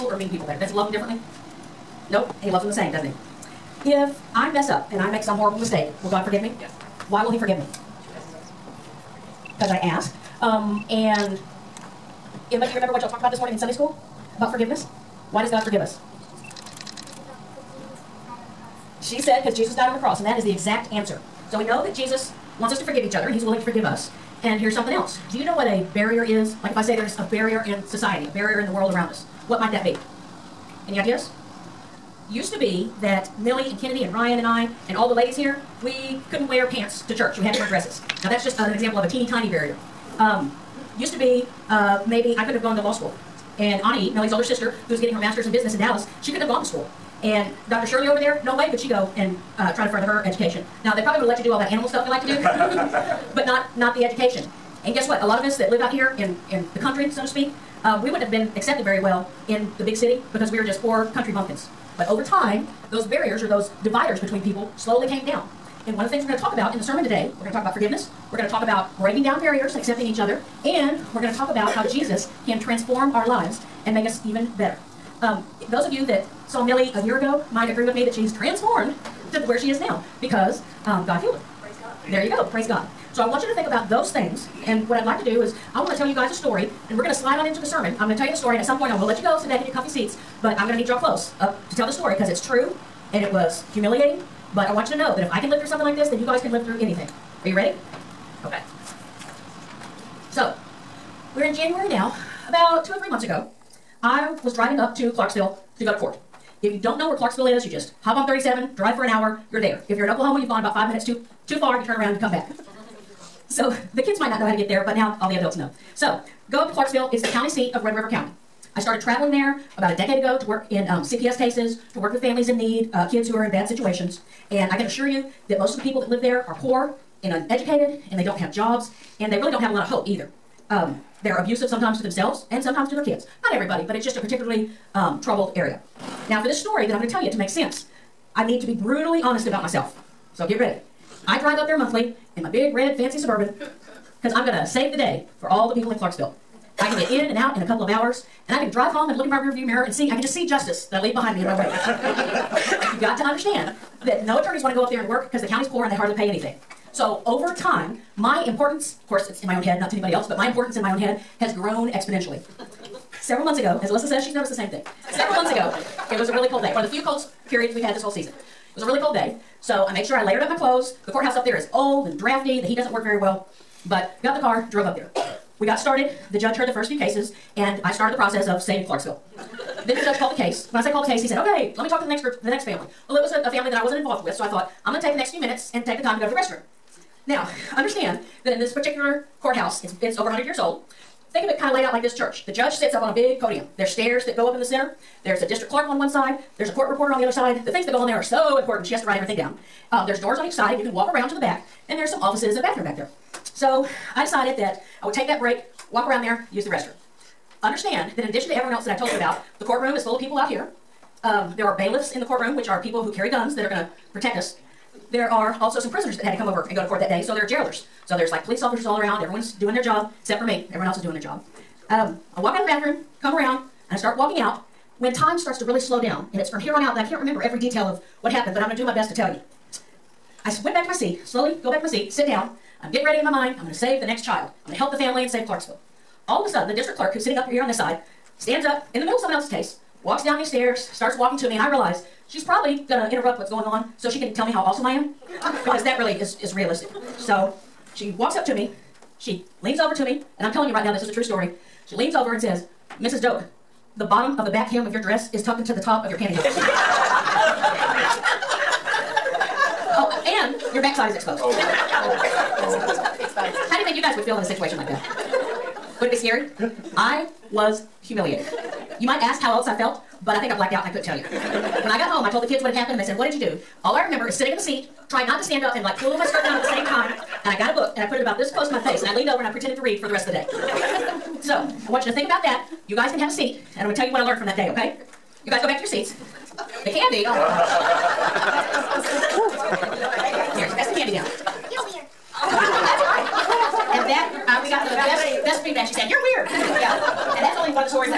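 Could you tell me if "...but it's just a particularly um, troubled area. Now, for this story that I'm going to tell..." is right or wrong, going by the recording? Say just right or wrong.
right.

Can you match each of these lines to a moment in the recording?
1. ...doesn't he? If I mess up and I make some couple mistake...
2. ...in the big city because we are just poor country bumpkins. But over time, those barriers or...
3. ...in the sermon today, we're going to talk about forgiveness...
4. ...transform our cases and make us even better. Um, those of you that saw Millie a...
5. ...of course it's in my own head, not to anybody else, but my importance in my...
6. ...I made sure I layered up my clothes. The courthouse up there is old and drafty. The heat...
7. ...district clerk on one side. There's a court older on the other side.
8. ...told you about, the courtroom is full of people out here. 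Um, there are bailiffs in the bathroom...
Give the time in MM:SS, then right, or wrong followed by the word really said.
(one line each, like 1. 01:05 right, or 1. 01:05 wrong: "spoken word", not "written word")
1. 00:02 wrong: "horrible", not "couple"
2. 00:59 right
3. 01:06 right
4. 01:12 wrong: "lives", not "cases"
5. 02:39 right
6. 02:49 right
7. 03:15 wrong: "reporter", not "older"
8. 03:28 wrong: "courtroom", not "bathroom".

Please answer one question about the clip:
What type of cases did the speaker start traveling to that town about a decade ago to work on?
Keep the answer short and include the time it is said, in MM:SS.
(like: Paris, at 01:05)
CPS cases, at 02:01.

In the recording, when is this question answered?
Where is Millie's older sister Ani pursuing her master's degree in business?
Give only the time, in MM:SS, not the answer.
00:45.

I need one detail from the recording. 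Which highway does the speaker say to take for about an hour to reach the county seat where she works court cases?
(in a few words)
37.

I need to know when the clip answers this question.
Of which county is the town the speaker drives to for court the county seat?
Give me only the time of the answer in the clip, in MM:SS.
01:57.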